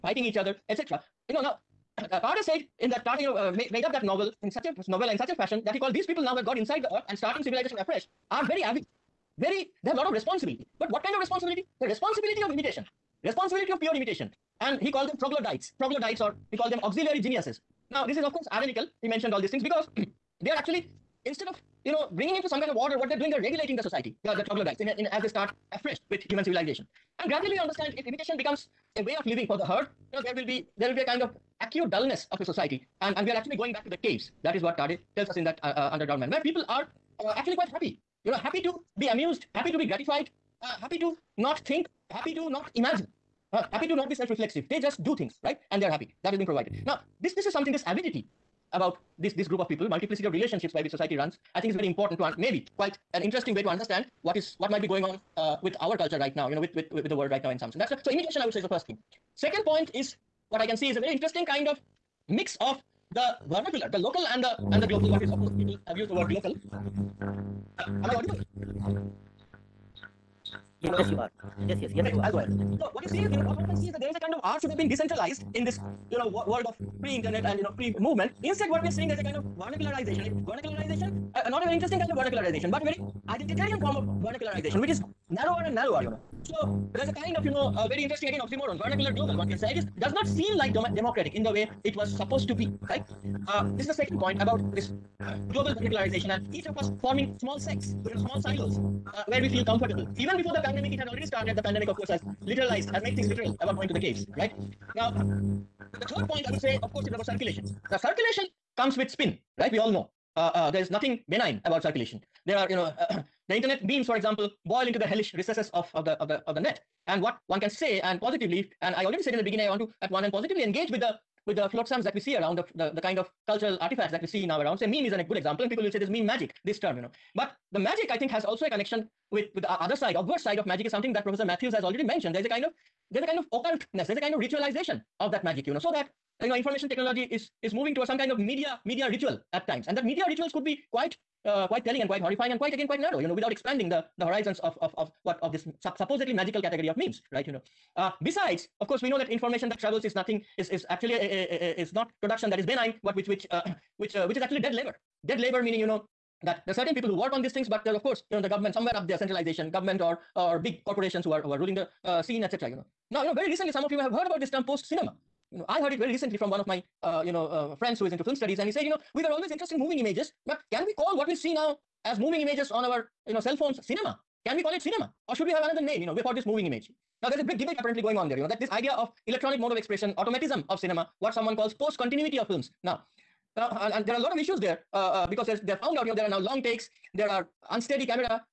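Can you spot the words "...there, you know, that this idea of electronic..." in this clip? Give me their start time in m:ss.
2:58.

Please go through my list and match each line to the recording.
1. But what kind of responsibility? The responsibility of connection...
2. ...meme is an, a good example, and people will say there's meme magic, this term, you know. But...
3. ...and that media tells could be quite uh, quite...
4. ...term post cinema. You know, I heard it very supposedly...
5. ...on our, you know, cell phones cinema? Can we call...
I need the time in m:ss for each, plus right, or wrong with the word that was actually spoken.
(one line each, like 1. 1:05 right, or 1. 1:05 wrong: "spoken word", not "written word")
1. 0:10 wrong: "imitation", not "connection"
2. 2:04 right
3. 2:19 wrong: "rituals", not "tells"
4. 2:44 wrong: "recently", not "supposedly"
5. 2:52 right.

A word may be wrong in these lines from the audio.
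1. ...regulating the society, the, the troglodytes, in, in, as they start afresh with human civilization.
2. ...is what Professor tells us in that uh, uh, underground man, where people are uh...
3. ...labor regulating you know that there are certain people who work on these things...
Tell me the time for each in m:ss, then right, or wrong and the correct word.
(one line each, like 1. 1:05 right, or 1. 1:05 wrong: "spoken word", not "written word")
1. 0:23 right
2. 0:34 wrong: "Tarde", not "Professor"
3. 2:35 wrong: "meaning", not "regulating".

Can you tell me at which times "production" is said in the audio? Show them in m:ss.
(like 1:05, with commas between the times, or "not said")
2:32.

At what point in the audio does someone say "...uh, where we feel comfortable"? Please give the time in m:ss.
1:39.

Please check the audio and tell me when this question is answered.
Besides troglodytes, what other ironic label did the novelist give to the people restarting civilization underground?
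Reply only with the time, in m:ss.
0:16.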